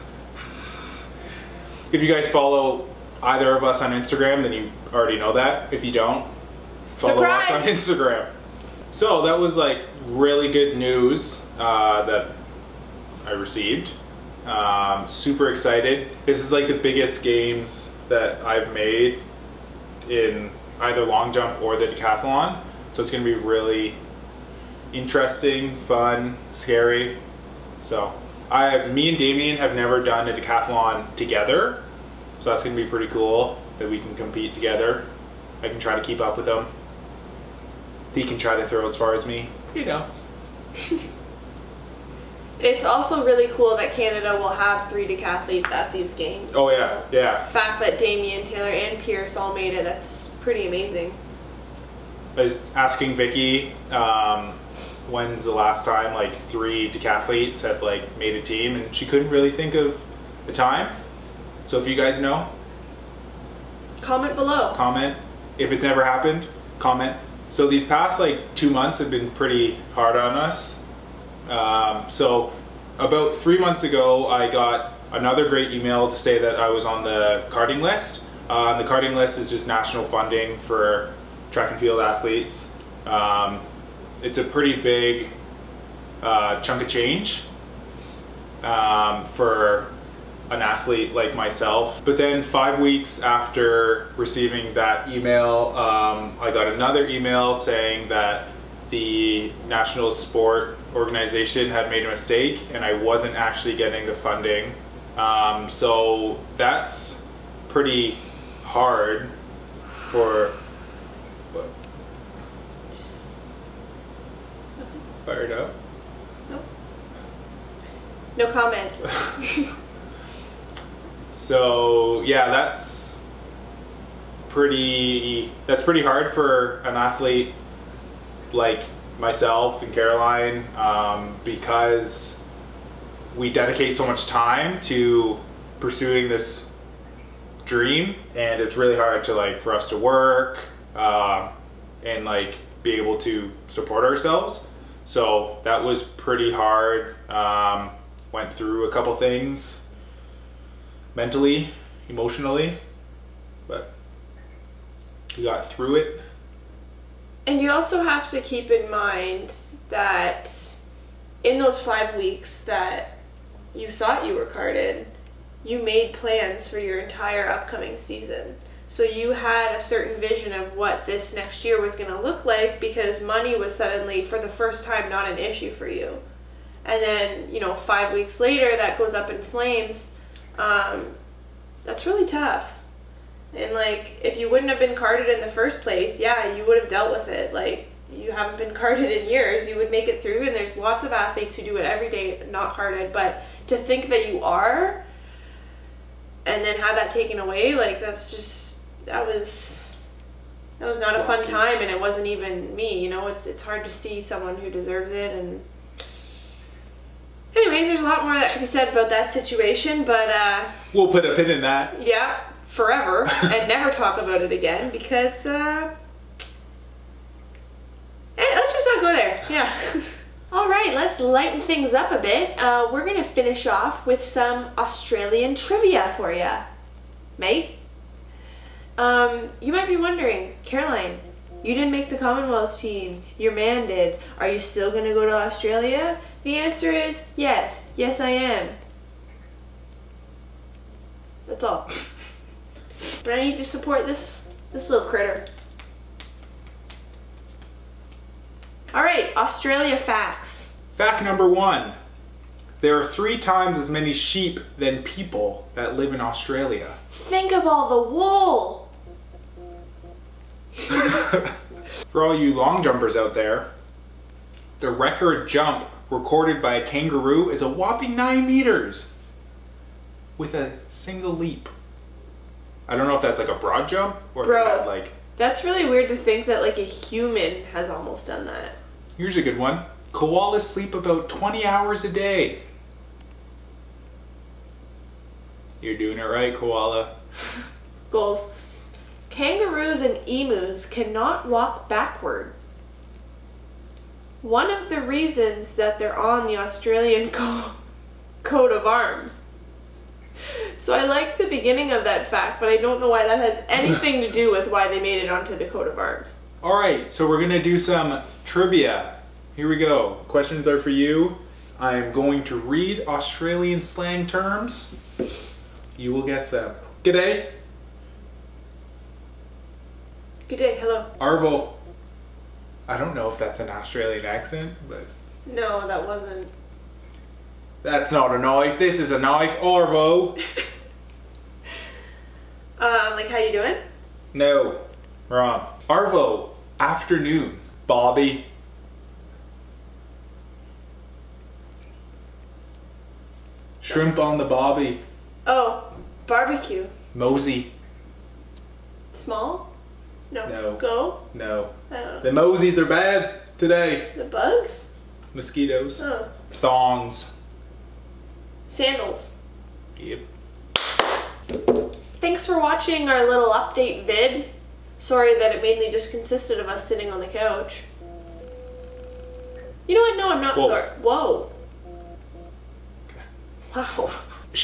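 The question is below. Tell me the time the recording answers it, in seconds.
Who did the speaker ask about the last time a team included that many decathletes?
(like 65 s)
53 s.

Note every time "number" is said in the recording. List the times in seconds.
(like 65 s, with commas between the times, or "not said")
251 s.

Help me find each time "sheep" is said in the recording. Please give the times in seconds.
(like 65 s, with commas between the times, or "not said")
254 s.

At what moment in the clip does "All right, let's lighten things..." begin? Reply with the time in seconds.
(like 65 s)
220 s.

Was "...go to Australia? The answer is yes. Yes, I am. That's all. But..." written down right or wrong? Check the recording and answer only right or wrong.
right.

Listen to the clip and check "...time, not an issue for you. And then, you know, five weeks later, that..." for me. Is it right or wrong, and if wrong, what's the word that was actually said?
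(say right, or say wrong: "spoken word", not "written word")
right.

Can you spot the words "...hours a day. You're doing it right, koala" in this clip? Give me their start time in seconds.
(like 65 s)
281 s.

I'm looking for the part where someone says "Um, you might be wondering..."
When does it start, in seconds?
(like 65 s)
228 s.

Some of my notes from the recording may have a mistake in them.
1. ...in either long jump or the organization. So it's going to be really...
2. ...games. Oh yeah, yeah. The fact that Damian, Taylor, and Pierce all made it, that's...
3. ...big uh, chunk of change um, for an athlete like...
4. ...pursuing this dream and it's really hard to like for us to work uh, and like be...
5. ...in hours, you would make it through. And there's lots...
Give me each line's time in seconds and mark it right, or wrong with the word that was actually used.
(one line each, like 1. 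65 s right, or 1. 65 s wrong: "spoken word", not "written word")
1. 20 s wrong: "decathlon", not "organization"
2. 46 s right
3. 84 s right
4. 135 s right
5. 189 s wrong: "years", not "hours".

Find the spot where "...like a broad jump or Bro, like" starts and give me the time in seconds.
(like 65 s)
273 s.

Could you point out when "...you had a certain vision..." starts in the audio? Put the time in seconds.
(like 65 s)
169 s.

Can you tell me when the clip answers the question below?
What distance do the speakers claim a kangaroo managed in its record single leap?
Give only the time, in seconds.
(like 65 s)
268 s.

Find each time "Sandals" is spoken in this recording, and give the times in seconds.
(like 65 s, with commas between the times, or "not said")
358 s.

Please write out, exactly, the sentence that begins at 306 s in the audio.
All right, so we're gonna do some trivia.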